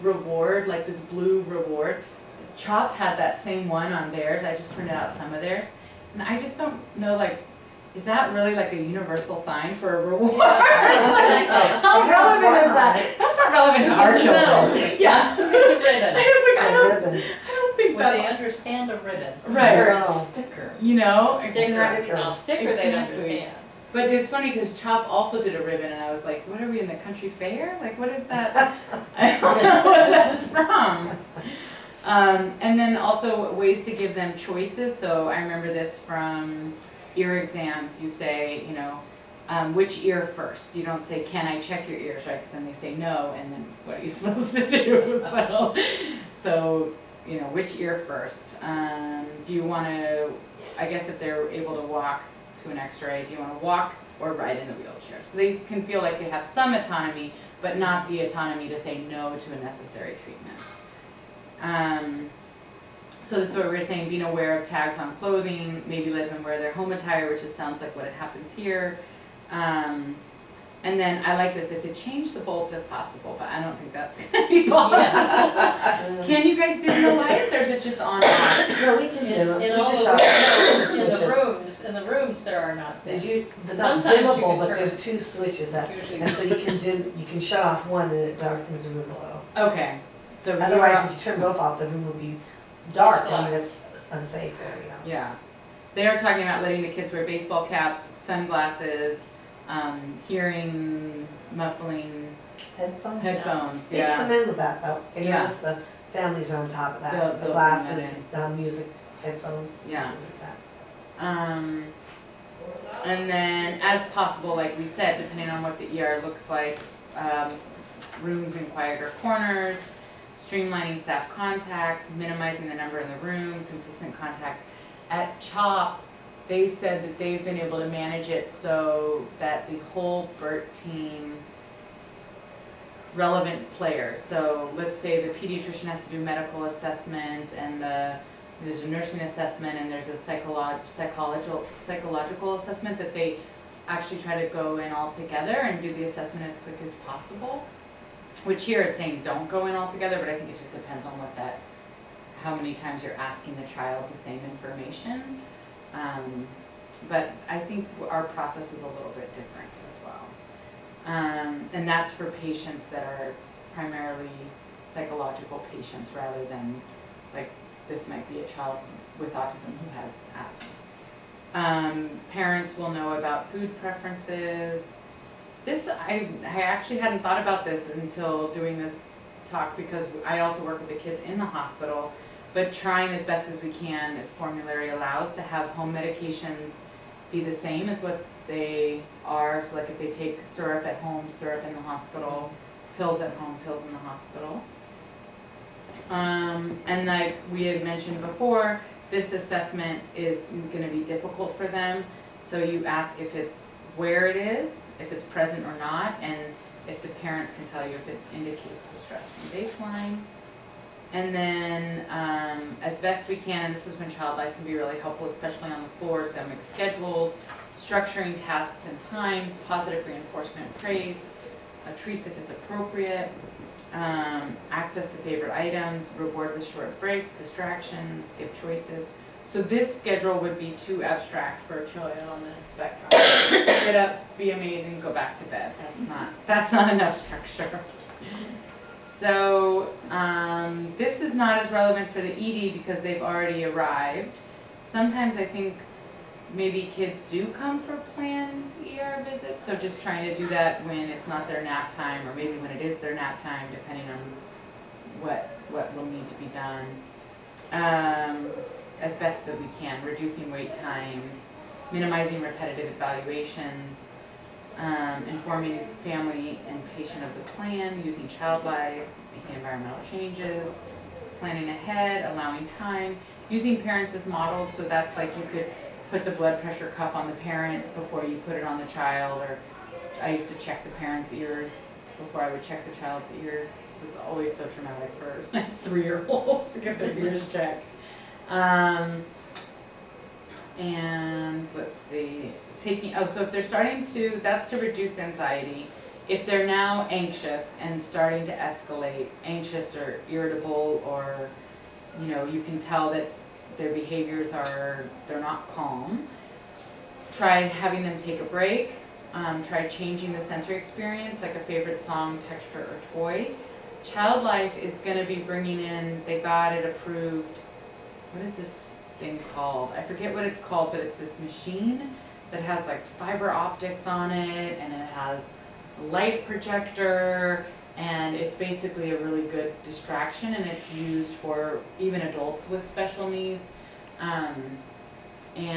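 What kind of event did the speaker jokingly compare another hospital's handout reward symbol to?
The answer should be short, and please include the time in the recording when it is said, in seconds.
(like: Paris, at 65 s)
country fair, at 26 s.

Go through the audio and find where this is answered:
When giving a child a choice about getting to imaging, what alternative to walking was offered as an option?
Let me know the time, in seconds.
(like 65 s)
54 s.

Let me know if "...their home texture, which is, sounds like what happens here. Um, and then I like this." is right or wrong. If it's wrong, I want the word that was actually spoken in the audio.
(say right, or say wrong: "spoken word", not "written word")
wrong: "attire", not "texture".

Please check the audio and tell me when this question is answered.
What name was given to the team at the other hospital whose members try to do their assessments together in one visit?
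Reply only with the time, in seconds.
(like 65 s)
130 s.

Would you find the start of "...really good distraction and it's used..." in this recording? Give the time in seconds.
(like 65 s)
329 s.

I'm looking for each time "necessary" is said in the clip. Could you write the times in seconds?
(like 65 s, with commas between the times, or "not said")
59 s.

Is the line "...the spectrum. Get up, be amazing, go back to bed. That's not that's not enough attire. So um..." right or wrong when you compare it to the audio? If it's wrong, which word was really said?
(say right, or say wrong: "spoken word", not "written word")
wrong: "structure", not "attire".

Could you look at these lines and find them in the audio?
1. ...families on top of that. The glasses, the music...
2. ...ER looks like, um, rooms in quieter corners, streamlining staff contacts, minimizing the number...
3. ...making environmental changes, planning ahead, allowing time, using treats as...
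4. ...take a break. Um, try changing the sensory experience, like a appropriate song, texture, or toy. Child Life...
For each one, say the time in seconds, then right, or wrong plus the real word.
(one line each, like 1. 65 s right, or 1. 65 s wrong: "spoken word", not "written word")
1. 106 s right
2. 115 s right
3. 269 s wrong: "parents", not "treats"
4. 308 s wrong: "favorite", not "appropriate".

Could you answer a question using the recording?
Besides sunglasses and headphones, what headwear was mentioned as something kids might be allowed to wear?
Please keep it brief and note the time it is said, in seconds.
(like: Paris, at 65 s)
baseball caps, at 97 s.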